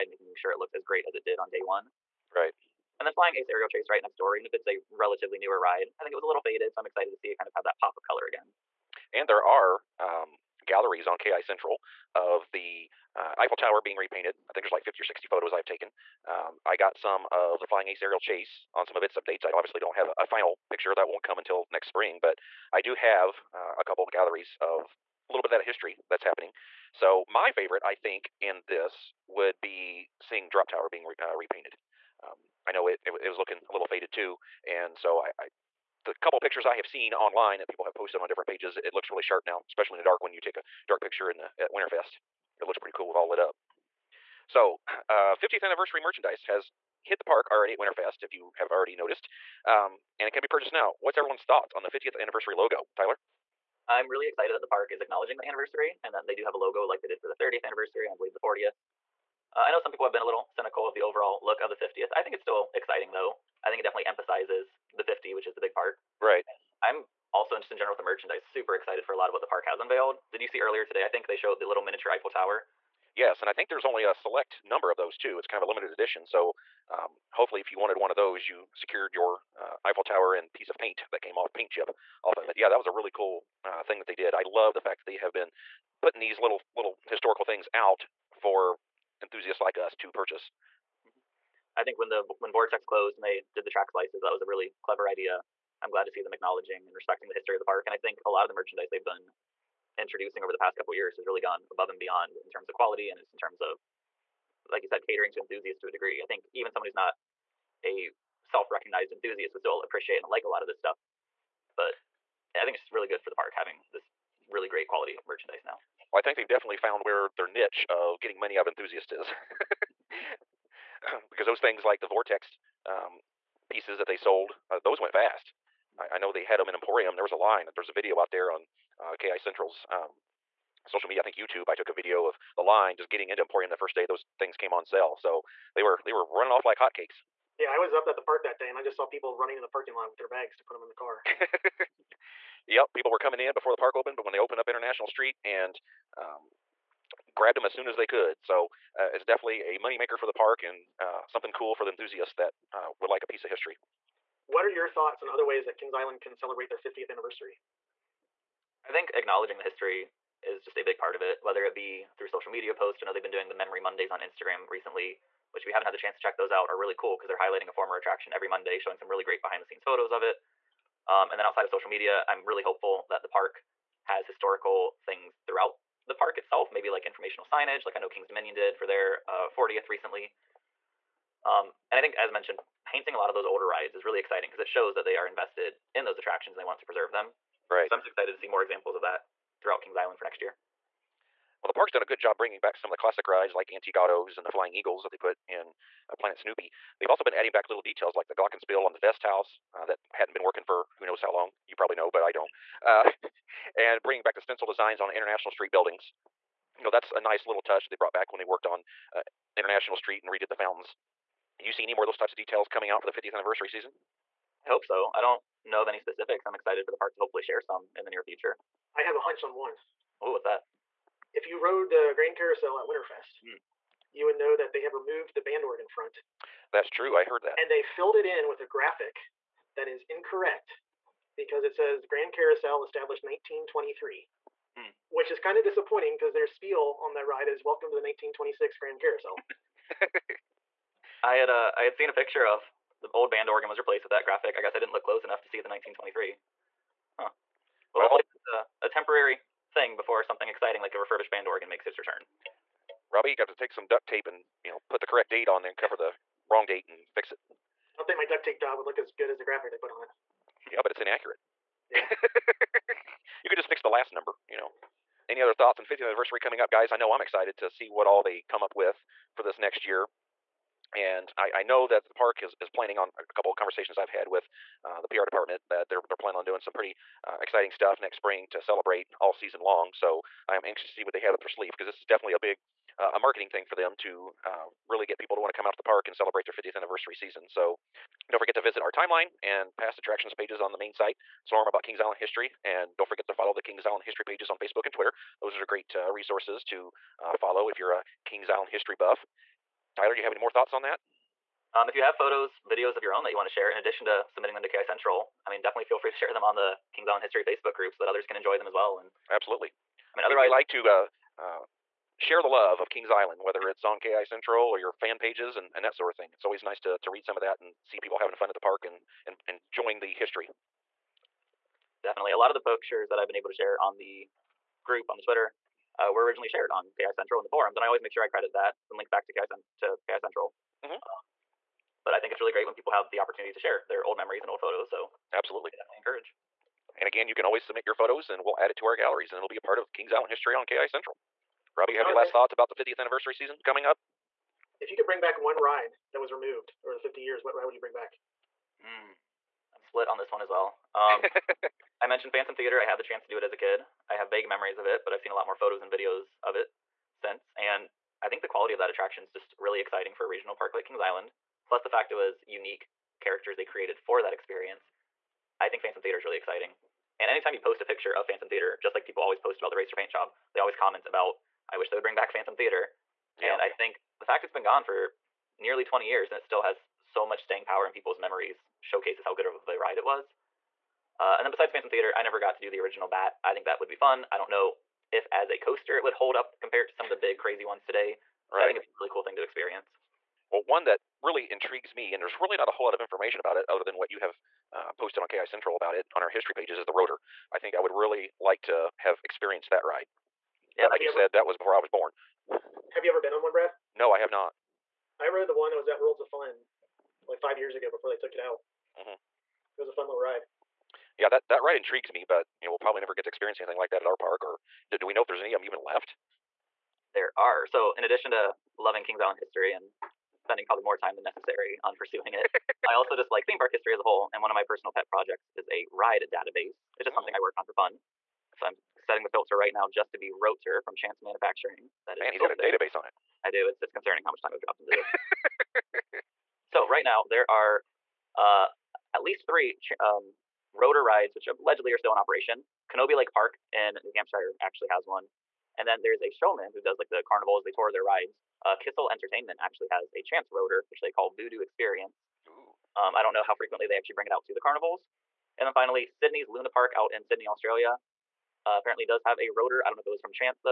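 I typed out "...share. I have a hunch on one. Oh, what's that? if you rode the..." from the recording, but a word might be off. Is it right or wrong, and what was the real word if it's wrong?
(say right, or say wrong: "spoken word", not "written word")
wrong: "future", not "share".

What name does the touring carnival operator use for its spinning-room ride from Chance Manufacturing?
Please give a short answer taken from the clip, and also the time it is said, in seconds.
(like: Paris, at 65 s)
Voodoo Experience, at 451 s.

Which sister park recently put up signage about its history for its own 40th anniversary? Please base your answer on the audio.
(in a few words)
Kings Dominion.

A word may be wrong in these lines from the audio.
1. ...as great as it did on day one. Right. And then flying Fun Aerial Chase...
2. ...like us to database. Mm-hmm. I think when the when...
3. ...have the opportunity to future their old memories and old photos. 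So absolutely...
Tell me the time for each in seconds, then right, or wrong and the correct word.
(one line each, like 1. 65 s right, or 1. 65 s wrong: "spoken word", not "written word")
1. 0 s wrong: "Ace", not "Fun"
2. 89 s wrong: "purchase", not "database"
3. 332 s wrong: "share", not "future".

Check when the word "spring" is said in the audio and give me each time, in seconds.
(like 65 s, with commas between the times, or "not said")
21 s, 278 s.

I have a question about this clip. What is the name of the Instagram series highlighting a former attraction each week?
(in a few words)
Memory Mondays.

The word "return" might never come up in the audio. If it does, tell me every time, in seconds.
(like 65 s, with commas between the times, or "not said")
251 s.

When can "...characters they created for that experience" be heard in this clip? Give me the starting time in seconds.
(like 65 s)
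363 s.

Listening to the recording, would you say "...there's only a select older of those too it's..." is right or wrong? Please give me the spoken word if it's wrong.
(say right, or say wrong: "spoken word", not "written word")
wrong: "number", not "older".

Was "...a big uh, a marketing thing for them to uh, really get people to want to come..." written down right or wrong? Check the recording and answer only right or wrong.
right.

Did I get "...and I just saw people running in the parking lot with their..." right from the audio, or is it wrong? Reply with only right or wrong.
right.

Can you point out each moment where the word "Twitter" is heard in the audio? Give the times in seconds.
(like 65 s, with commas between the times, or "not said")
294 s, 325 s.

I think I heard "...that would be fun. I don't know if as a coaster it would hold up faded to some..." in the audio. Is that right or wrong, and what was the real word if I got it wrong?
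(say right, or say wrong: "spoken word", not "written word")
wrong: "compared", not "faded".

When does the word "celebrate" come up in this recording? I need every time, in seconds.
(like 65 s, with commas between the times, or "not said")
156 s, 278 s, 286 s.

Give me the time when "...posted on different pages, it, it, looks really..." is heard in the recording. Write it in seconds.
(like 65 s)
37 s.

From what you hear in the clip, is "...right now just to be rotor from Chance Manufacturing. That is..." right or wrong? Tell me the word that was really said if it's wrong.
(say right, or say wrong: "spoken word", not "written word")
right.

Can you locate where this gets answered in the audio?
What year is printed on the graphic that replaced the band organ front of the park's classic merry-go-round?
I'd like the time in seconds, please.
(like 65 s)
232 s.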